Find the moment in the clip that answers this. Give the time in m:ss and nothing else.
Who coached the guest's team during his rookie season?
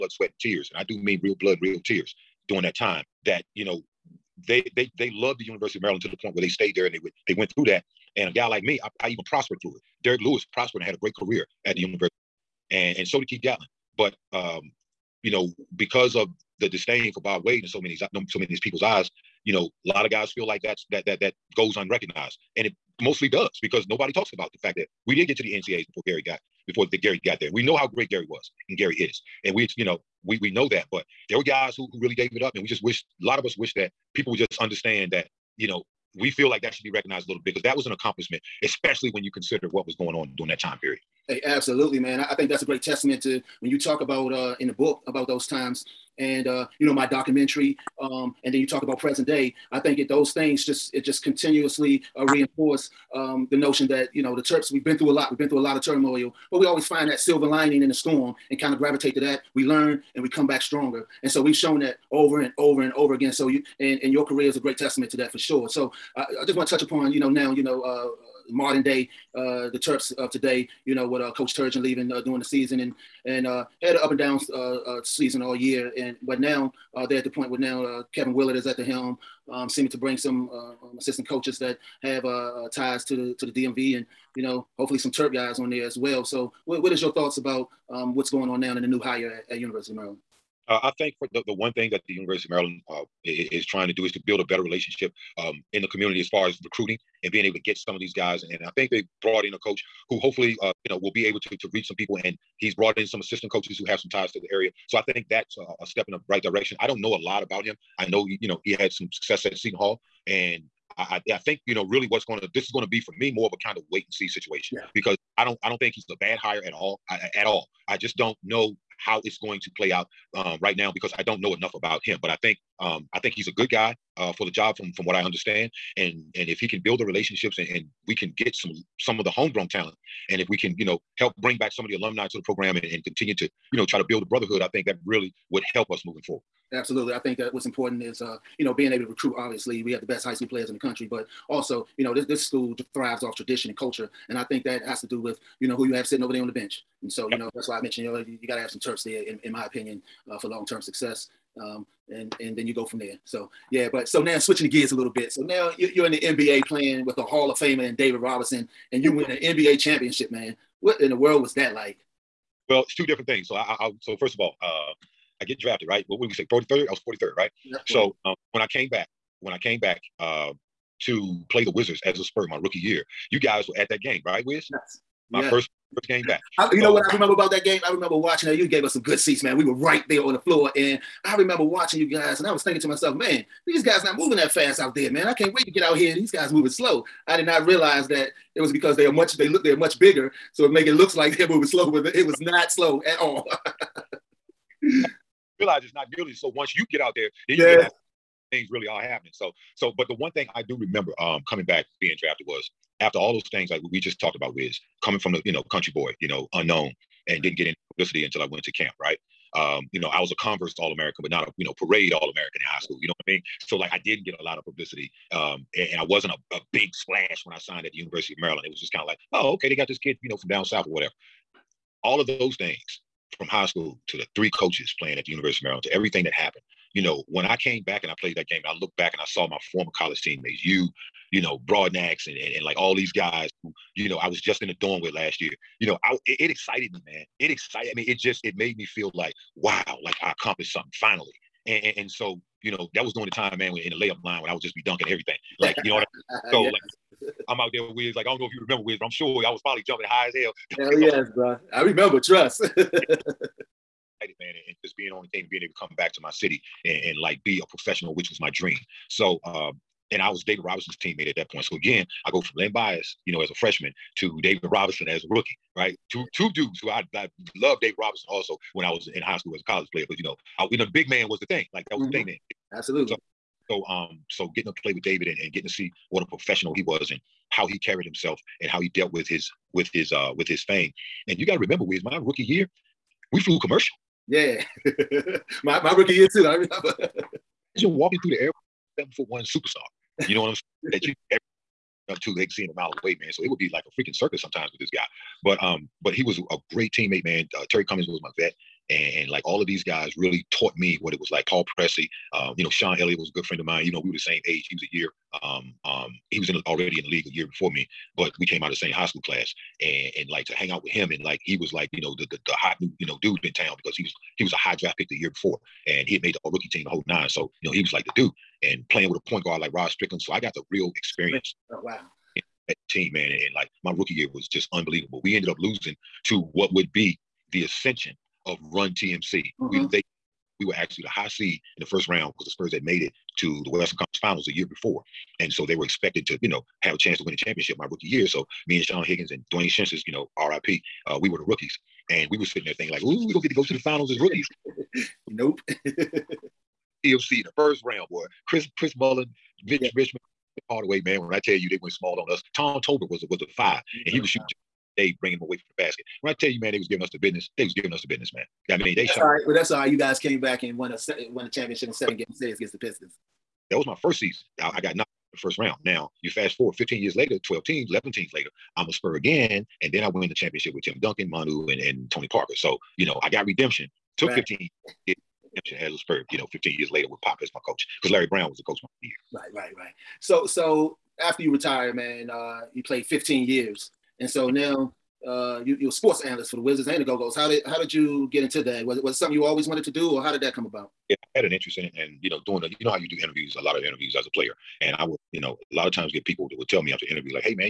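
6:18.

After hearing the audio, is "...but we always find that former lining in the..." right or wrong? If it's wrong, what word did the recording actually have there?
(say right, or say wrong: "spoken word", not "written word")
wrong: "silver", not "former".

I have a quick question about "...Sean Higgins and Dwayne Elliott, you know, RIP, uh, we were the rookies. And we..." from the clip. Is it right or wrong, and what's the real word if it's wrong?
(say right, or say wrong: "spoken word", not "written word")
wrong: "Schintzius", not "Elliott".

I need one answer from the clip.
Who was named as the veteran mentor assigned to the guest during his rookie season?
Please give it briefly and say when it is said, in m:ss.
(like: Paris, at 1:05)
Terry Cummings, at 4:57.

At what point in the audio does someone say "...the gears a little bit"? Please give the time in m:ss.
2:34.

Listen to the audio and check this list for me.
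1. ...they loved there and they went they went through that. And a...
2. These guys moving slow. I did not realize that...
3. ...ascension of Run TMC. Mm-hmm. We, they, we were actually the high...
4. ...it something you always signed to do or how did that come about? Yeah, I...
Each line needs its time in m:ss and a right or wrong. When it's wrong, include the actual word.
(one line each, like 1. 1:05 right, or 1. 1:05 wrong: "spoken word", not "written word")
1. 0:06 wrong: "stayed", not "loved"
2. 3:06 right
3. 5:27 right
4. 6:29 wrong: "wanted", not "signed".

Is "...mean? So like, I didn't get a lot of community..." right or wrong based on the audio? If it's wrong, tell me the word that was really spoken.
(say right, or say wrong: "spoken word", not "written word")
wrong: "publicity", not "community".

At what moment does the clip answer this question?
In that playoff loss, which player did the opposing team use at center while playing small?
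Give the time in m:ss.
5:52.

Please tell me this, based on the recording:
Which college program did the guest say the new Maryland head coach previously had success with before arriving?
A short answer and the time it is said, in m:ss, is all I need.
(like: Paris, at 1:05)
Seton Hall, at 1:49.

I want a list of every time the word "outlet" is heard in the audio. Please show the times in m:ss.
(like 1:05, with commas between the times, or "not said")
not said.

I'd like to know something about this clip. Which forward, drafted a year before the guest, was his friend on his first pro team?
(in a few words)
Sean Elliott.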